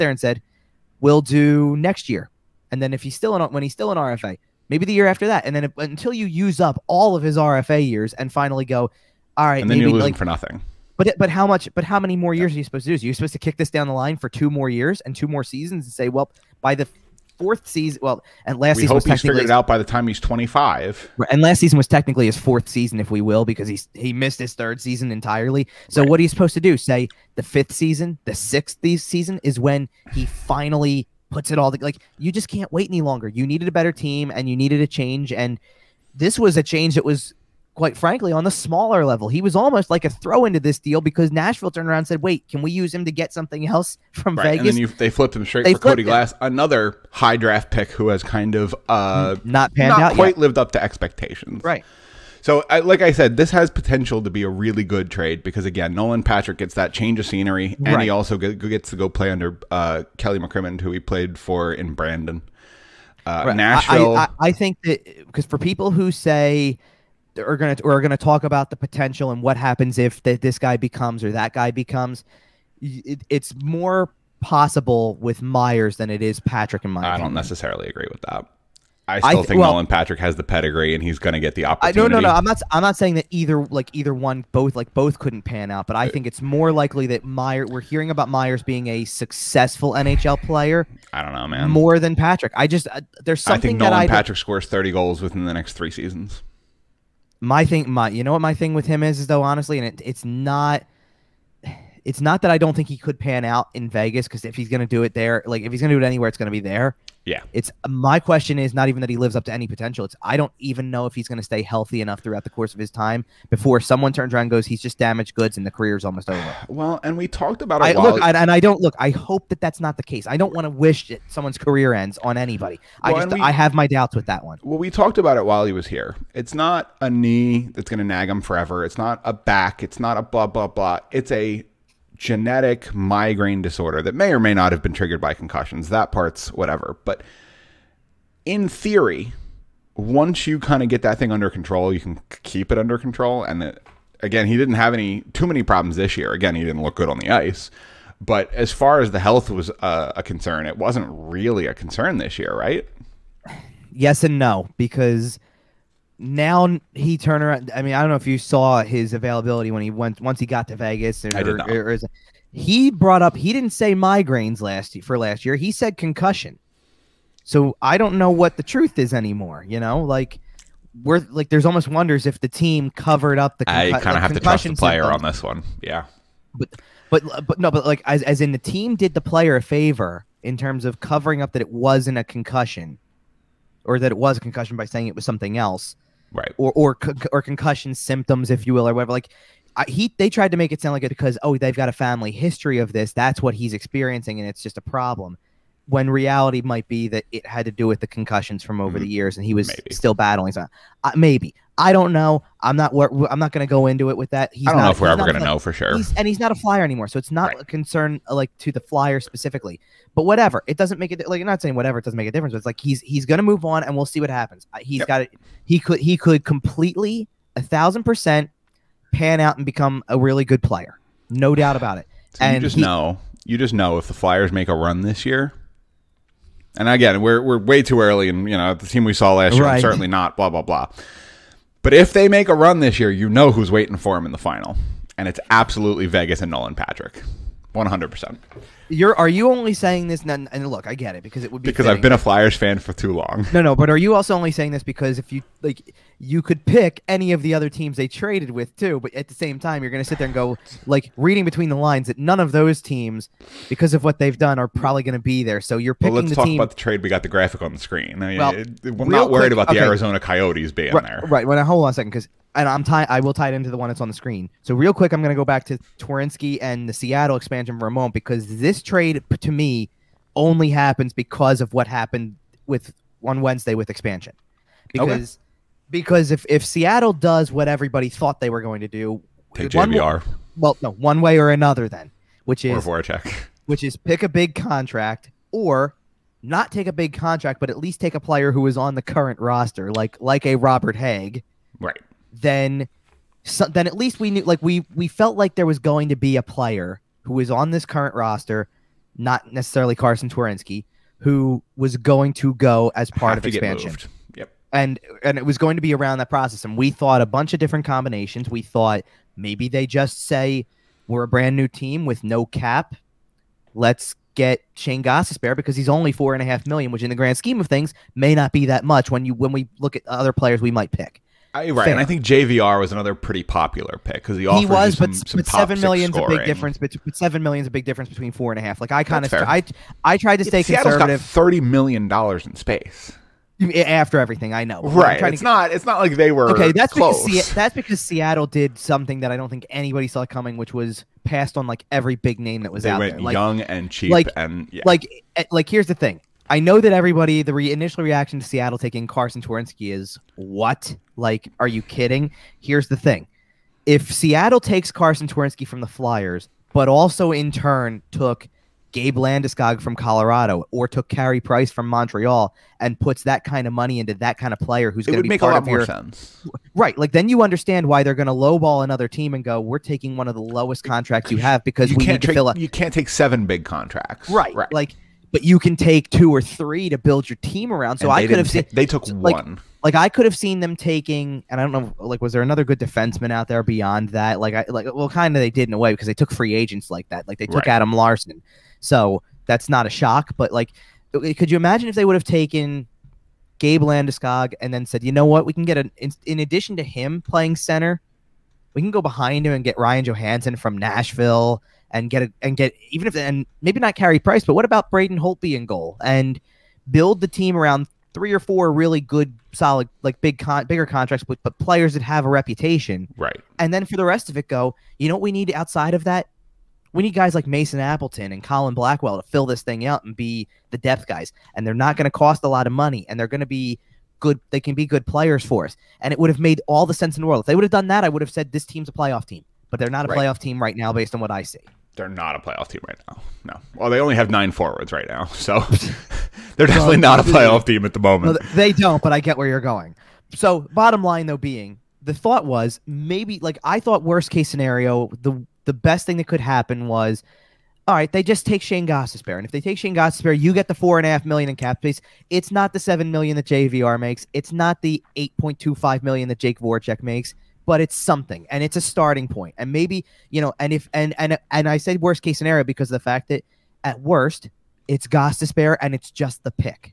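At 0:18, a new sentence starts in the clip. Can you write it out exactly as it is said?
Well, and last we season hope was he's figured it out by the time he's twenty five.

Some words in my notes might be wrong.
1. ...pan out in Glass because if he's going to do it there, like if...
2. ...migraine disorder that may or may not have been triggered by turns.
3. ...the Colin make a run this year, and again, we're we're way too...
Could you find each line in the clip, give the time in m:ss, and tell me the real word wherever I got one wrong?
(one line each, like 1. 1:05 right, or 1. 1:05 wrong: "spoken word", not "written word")
1. 1:43 wrong: "Vegas", not "Glass"
2. 2:12 wrong: "concussions", not "turns"
3. 3:44 wrong: "Flyers", not "Colin".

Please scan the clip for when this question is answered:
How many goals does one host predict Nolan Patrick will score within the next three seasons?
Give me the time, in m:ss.
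1:34.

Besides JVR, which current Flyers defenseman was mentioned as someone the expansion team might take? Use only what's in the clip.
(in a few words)
Robert Hagg.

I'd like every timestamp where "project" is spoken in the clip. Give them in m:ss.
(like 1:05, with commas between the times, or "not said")
not said.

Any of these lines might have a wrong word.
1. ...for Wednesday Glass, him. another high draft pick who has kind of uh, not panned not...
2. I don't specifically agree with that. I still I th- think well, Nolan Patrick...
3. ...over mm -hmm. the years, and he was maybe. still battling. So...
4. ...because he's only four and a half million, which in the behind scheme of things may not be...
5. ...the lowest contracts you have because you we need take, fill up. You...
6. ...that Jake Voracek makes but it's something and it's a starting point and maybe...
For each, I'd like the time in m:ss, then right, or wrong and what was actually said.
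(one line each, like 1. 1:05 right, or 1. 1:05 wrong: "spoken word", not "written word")
1. 0:45 wrong: "Cody", not "Wednesday"
2. 1:17 wrong: "necessarily", not "specifically"
3. 3:18 right
4. 5:15 wrong: "grand", not "behind"
5. 6:10 right
6. 7:36 right.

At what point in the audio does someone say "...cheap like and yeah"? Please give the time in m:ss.
5:43.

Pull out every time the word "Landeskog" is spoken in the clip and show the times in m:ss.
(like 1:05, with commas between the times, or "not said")
5:59, 6:33.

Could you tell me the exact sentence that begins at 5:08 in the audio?
We thought maybe they just say we're a brand new team with no cap.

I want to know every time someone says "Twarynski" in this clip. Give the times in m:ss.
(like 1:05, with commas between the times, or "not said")
4:25, 5:00, 5:49, 5:55.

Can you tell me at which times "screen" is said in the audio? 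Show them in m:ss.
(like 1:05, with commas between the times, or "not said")
4:17, 4:24.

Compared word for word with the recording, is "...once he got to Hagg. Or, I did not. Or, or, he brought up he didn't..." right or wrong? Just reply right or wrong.
wrong.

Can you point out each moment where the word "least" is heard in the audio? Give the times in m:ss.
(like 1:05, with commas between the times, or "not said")
4:47, 4:53.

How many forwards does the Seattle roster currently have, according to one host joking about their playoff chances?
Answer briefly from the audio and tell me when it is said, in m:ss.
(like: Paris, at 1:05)
9, at 7:14.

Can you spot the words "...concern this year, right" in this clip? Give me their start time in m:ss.
2:31.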